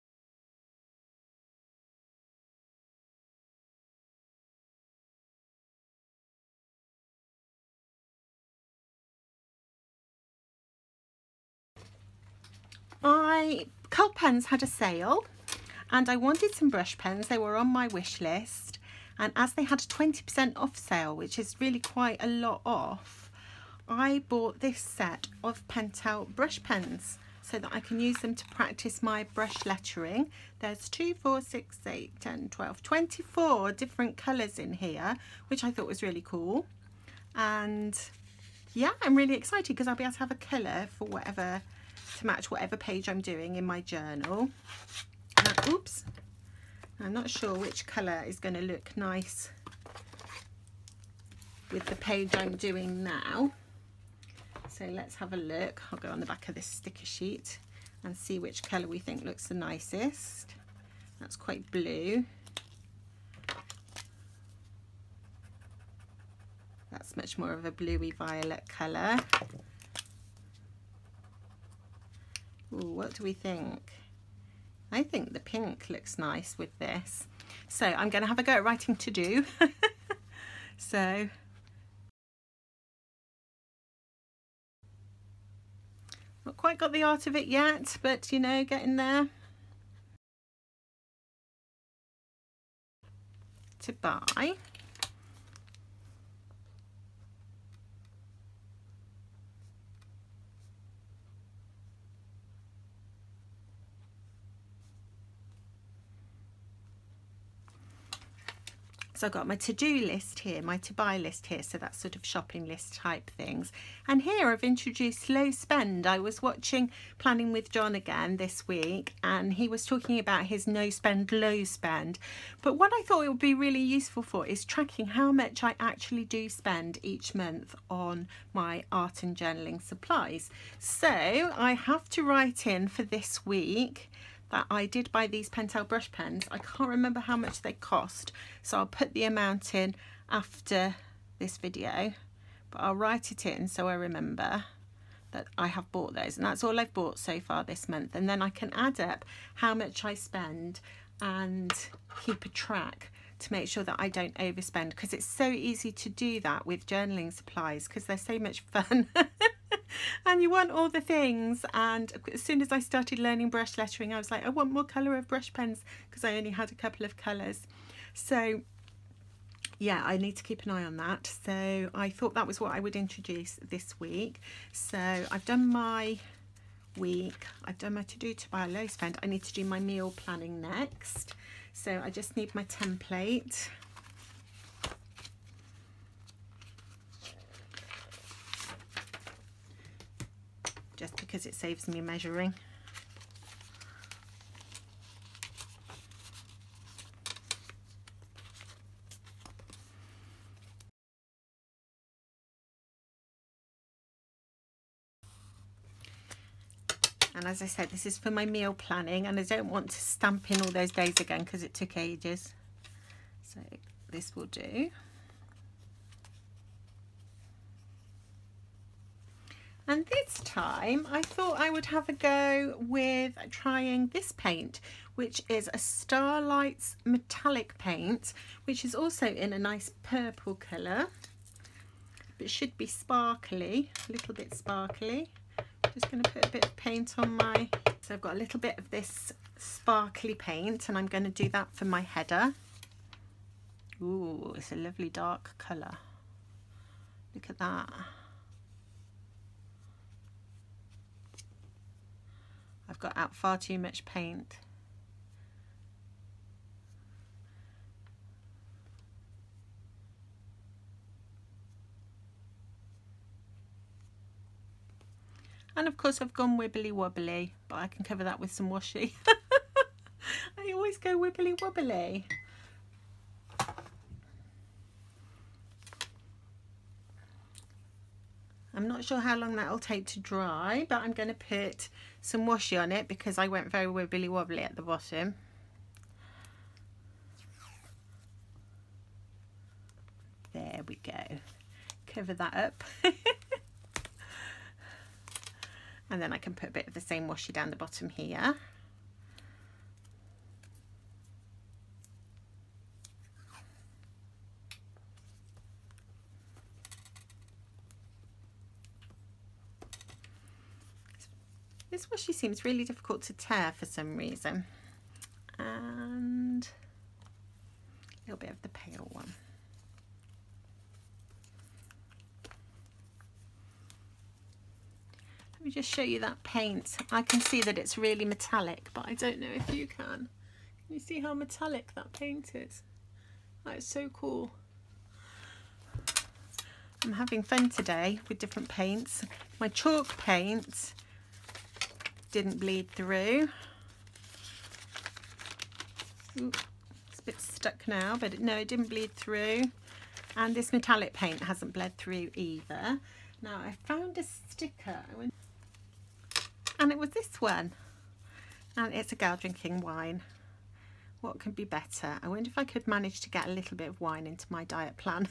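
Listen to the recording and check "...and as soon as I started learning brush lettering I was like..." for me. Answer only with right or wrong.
right.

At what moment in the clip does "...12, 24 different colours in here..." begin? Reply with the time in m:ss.
0:32.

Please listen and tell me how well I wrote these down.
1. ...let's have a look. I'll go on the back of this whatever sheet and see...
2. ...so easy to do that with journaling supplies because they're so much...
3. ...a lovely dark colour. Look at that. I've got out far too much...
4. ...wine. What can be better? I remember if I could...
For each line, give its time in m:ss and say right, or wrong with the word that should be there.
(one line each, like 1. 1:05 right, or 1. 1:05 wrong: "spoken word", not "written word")
1. 0:54 wrong: "sticker", not "whatever"
2. 2:35 right
3. 4:04 right
4. 5:59 wrong: "wonder", not "remember".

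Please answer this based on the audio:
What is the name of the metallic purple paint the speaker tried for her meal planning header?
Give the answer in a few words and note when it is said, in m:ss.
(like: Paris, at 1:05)
Starlight's, at 3:45.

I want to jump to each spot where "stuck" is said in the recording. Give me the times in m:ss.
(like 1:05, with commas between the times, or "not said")
5:47.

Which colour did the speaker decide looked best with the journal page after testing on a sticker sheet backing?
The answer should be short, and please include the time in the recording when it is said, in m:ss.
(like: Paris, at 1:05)
pink, at 1:15.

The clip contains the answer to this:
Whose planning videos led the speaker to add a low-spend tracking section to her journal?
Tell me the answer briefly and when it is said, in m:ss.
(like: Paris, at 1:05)
John, at 1:57.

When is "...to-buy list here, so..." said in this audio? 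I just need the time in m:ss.
1:50.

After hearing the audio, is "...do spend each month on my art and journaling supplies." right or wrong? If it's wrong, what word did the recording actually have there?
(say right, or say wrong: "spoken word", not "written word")
right.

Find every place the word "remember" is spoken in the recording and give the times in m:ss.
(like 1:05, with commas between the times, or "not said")
2:16, 2:23.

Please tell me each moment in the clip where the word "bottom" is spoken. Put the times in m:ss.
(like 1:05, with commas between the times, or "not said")
4:44, 4:57.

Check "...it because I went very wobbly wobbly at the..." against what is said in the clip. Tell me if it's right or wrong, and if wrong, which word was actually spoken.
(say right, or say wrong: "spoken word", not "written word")
wrong: "wibbly", not "wobbly".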